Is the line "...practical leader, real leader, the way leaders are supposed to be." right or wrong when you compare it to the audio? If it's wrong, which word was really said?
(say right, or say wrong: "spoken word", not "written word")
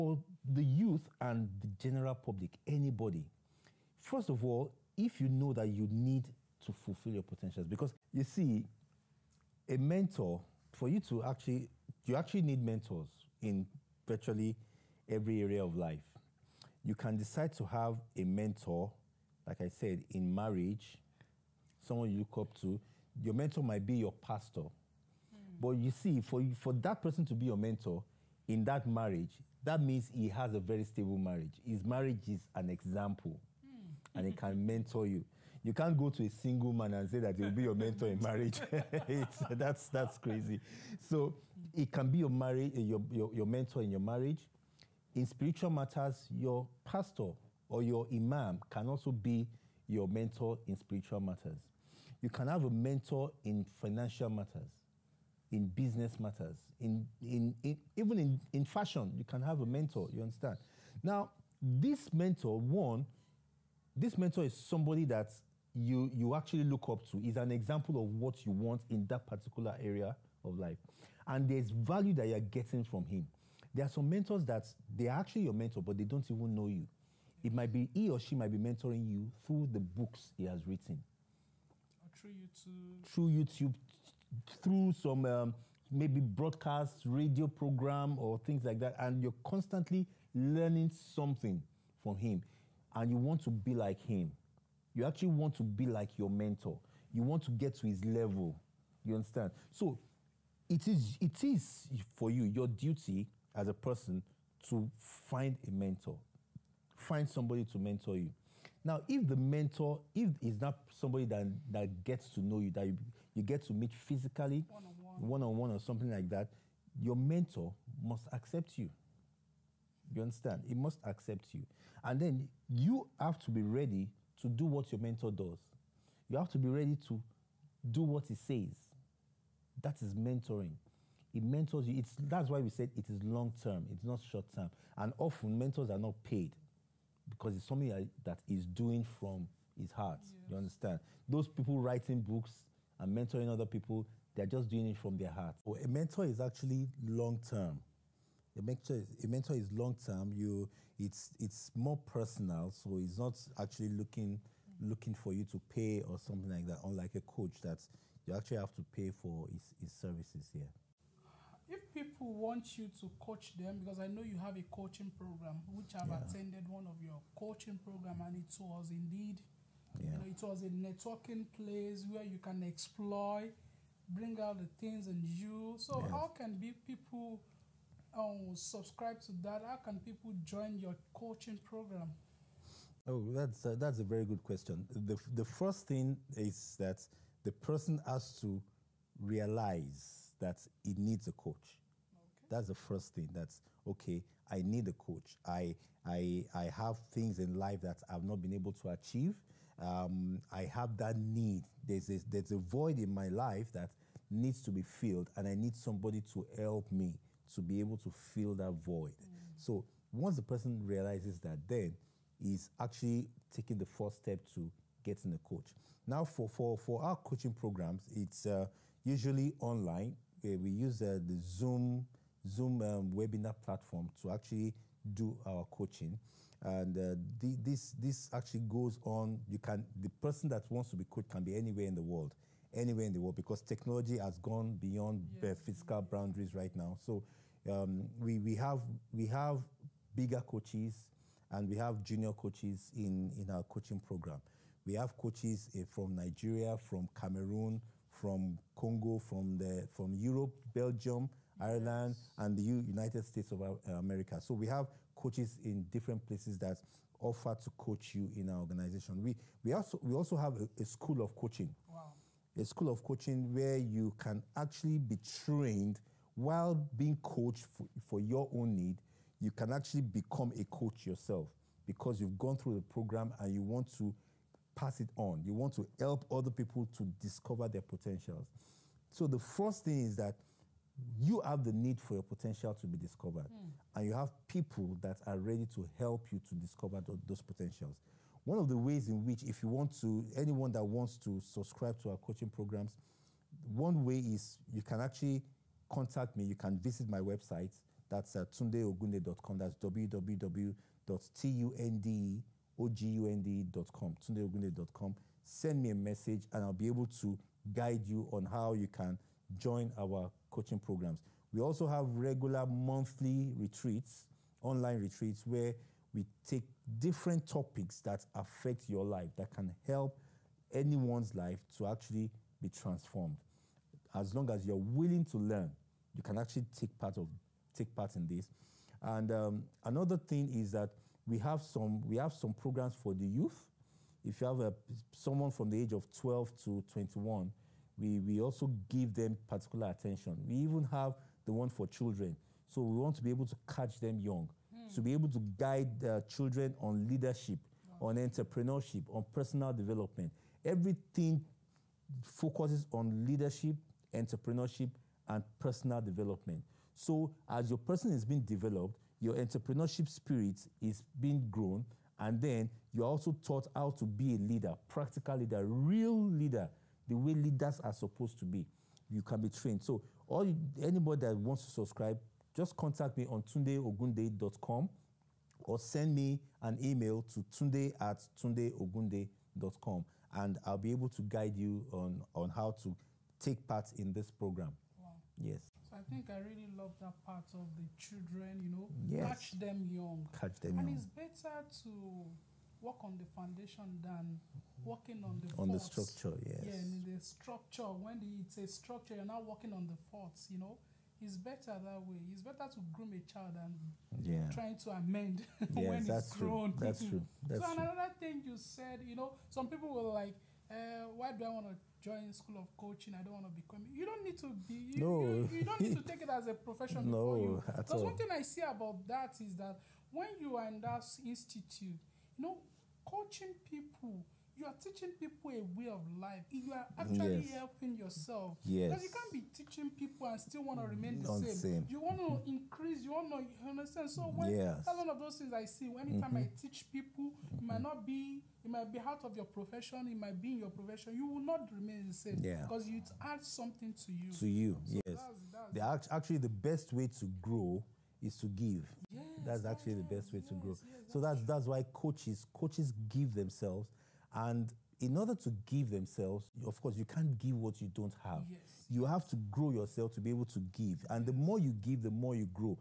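right.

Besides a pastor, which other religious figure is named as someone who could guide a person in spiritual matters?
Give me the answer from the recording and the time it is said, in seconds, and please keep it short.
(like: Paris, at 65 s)
Imam, at 48 s.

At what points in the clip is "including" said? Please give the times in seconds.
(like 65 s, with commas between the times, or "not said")
not said.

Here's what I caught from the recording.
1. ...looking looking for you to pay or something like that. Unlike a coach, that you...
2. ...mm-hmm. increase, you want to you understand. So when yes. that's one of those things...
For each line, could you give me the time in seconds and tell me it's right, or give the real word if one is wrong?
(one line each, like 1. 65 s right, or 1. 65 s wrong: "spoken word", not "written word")
1. 153 s right
2. 432 s right.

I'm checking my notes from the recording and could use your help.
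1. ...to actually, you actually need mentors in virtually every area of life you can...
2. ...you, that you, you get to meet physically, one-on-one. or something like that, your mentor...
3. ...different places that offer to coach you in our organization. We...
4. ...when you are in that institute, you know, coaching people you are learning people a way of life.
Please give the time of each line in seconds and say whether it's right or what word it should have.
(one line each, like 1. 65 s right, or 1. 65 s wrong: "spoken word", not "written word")
1. 11 s right
2. 112 s right
3. 255 s right
4. 420 s wrong: "teaching", not "learning".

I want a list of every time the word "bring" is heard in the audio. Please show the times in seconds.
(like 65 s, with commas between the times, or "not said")
174 s.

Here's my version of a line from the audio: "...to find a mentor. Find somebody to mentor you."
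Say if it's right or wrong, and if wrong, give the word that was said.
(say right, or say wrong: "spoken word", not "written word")
right.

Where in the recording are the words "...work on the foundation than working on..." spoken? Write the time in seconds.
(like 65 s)
392 s.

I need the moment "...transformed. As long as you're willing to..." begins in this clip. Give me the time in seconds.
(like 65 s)
322 s.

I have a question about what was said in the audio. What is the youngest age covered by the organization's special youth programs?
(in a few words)
12.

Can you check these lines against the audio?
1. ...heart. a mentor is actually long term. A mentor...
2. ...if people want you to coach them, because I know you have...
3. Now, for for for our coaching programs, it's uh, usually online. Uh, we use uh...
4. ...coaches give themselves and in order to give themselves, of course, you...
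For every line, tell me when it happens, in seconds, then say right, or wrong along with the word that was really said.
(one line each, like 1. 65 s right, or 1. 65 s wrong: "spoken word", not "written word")
1. 145 s right
2. 161 s right
3. 216 s right
4. 452 s right.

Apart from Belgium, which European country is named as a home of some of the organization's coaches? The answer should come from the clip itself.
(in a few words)
Ireland.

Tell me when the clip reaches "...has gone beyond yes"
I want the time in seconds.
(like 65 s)
234 s.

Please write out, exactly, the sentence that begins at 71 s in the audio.
And there's value that you're getting from him.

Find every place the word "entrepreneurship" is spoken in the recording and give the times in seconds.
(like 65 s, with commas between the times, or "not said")
348 s, 354 s, 359 s.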